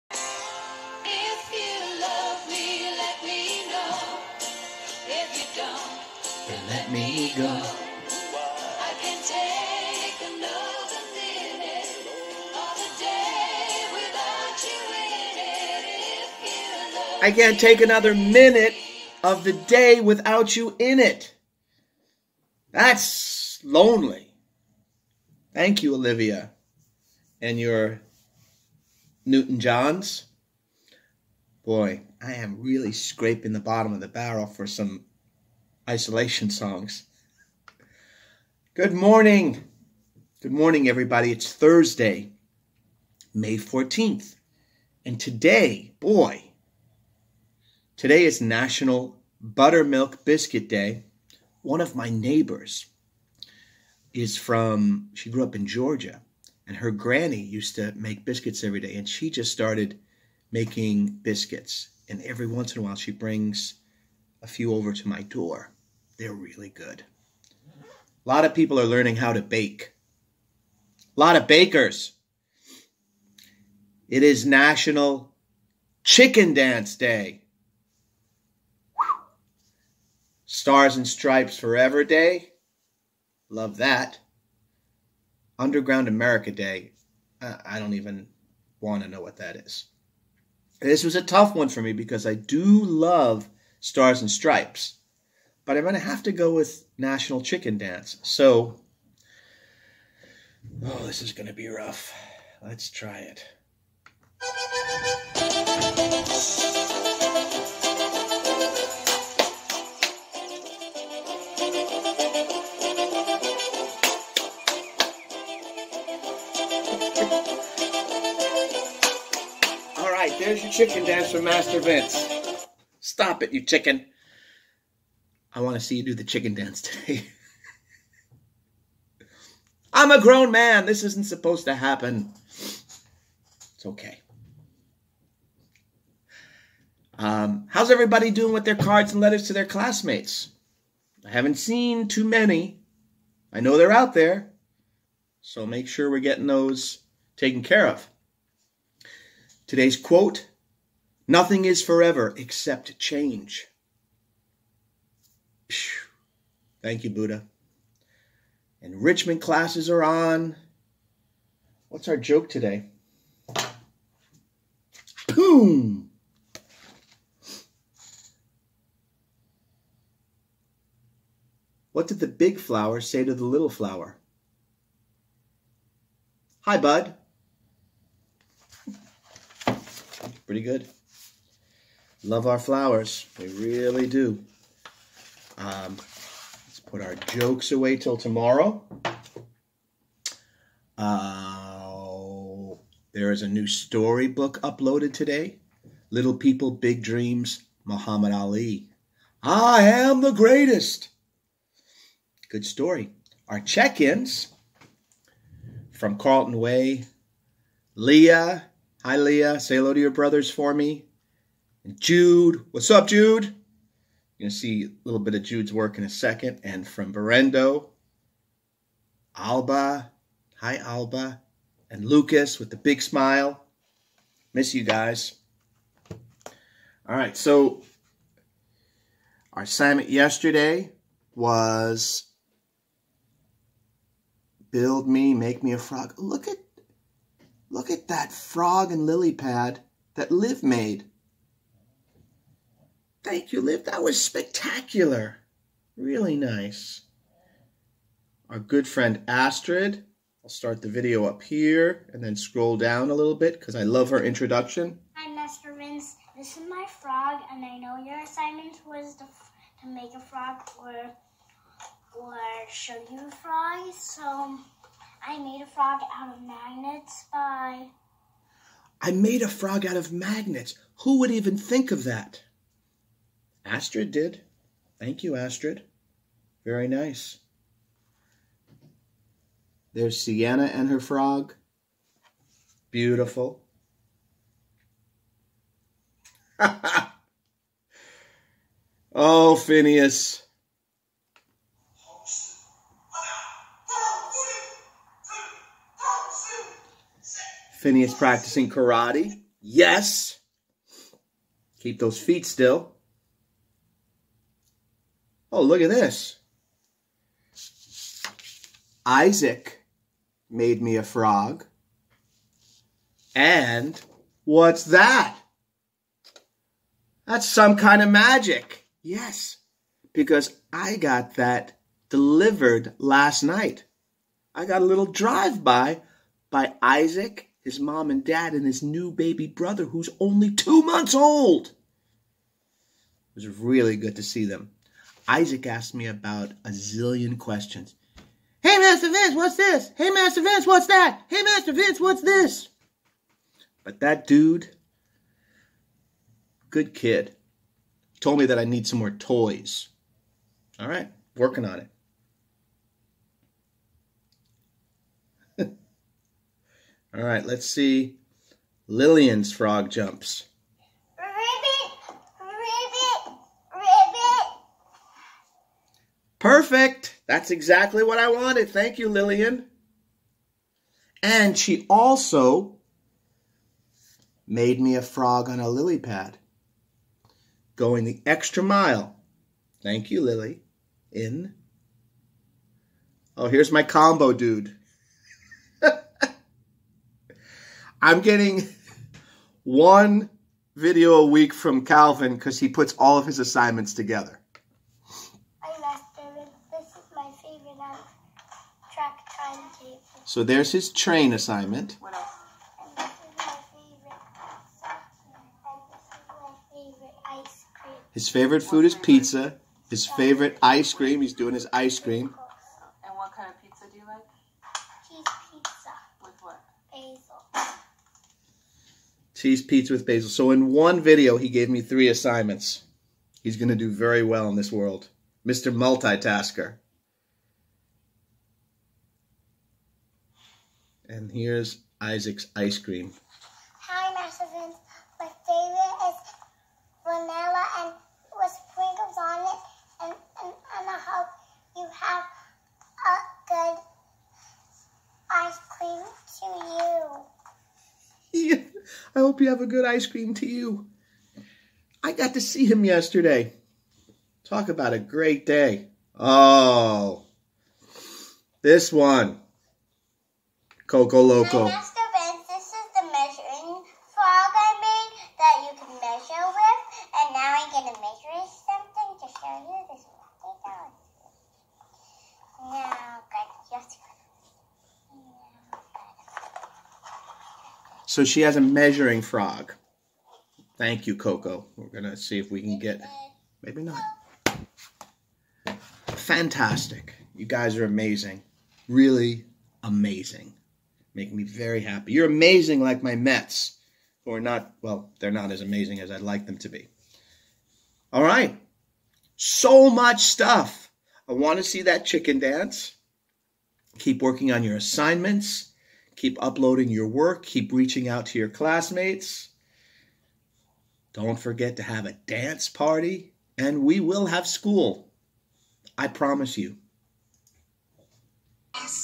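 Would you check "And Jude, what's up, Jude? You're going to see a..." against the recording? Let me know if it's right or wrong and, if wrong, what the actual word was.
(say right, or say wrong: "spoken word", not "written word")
right.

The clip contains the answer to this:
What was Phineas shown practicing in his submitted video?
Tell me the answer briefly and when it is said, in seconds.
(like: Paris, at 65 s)
Karate, at 298 s.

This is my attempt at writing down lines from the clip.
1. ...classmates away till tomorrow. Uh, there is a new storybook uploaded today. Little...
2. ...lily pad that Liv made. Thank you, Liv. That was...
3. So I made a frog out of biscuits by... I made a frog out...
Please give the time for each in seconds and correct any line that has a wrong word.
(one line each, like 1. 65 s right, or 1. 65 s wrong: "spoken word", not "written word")
1. 187 s wrong: "jokes", not "classmates"
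2. 239 s right
3. 263 s wrong: "magnets", not "biscuits".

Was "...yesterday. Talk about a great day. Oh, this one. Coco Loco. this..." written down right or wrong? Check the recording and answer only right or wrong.
right.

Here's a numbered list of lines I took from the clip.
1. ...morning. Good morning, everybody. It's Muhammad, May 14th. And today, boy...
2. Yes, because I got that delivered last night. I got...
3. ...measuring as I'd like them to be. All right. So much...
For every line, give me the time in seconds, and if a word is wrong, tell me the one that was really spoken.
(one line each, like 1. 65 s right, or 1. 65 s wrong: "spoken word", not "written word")
1. 38 s wrong: "Thursday", not "Muhammad"
2. 319 s right
3. 495 s wrong: "amazing", not "measuring".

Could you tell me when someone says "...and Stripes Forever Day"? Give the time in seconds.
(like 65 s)
80 s.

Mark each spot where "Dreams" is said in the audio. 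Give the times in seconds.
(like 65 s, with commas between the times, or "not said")
197 s.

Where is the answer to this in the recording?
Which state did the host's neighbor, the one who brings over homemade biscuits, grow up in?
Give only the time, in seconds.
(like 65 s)
55 s.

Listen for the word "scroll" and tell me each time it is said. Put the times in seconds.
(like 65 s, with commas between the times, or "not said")
252 s.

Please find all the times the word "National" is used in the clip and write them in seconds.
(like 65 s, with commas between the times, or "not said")
48 s, 74 s, 96 s.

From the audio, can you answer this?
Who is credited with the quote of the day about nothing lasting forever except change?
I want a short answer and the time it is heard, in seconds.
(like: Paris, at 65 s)
Buddha, at 157 s.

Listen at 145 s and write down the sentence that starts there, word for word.
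So make sure we're getting those taken care of.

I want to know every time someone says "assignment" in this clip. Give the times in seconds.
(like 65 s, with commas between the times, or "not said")
229 s, 258 s, 393 s, 401 s, 422 s, 504 s.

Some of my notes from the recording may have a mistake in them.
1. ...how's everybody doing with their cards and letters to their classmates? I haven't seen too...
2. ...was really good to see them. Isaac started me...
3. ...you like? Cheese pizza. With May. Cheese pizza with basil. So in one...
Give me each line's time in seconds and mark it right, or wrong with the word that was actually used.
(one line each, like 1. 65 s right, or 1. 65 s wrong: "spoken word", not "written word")
1. 137 s right
2. 333 s wrong: "asked", not "started"
3. 413 s wrong: "Basil", not "May".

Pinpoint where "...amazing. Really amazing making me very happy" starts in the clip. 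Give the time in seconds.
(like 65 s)
487 s.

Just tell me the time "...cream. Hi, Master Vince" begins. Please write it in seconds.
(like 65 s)
432 s.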